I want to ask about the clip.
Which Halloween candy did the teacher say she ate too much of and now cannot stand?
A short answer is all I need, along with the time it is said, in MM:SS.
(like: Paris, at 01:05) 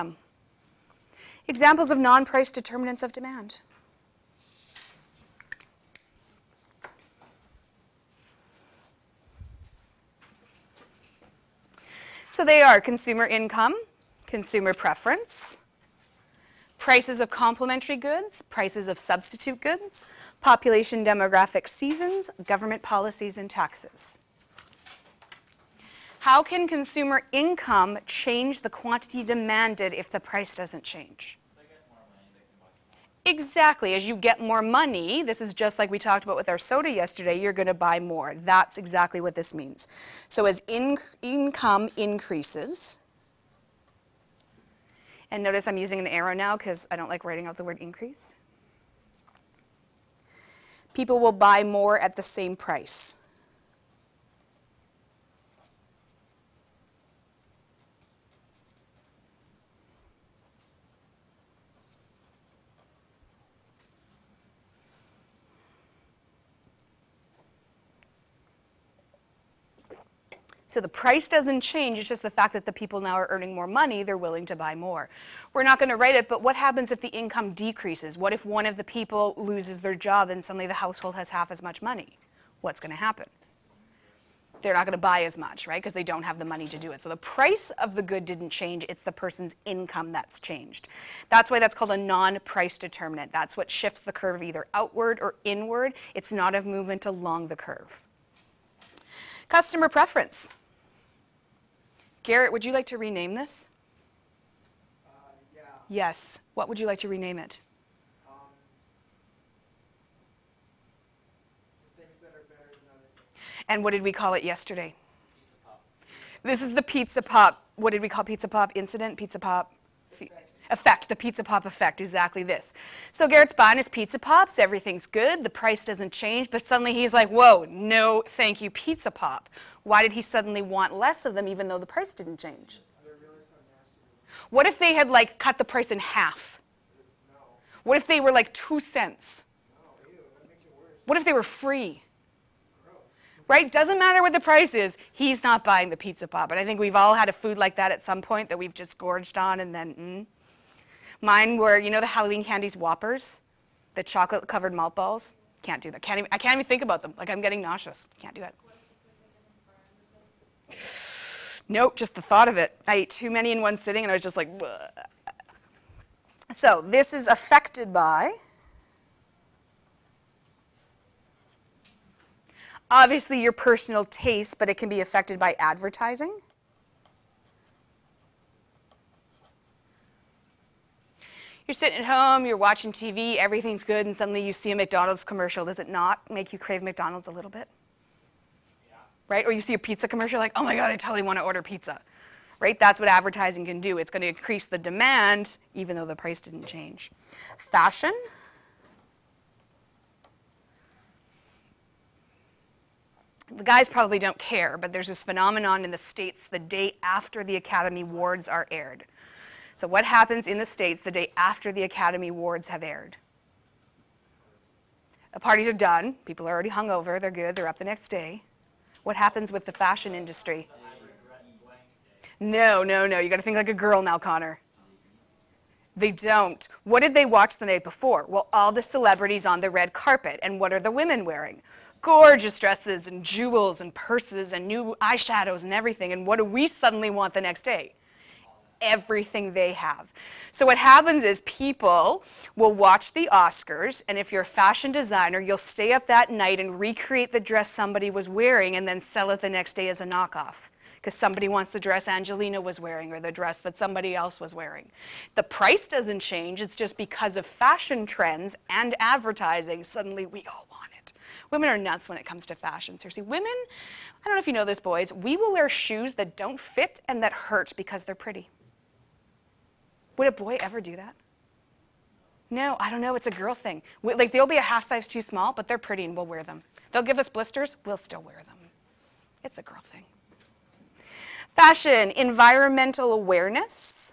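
Whoppers, at 02:32.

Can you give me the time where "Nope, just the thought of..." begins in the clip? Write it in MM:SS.
02:41.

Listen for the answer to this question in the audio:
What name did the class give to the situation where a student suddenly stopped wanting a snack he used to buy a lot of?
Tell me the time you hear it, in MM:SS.
02:01.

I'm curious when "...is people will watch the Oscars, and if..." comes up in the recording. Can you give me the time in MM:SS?
04:01.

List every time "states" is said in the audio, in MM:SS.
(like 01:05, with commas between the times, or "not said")
03:25, 03:30.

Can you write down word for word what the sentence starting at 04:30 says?
Would a boy ever do that?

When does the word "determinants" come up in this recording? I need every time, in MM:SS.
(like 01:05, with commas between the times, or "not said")
00:02, 01:32.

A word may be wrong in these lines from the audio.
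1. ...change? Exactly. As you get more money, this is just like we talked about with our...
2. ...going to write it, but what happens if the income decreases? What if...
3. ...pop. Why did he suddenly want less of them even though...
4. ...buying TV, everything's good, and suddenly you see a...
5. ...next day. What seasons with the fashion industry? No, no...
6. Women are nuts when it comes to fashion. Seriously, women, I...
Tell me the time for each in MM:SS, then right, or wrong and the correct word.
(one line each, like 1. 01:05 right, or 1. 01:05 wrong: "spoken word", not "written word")
1. 00:30 right
2. 01:15 right
3. 02:09 right
4. 03:02 wrong: "watching", not "buying"
5. 03:37 wrong: "happens", not "seasons"
6. 04:21 right.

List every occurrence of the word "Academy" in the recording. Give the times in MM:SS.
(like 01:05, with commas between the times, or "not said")
03:27, 03:31.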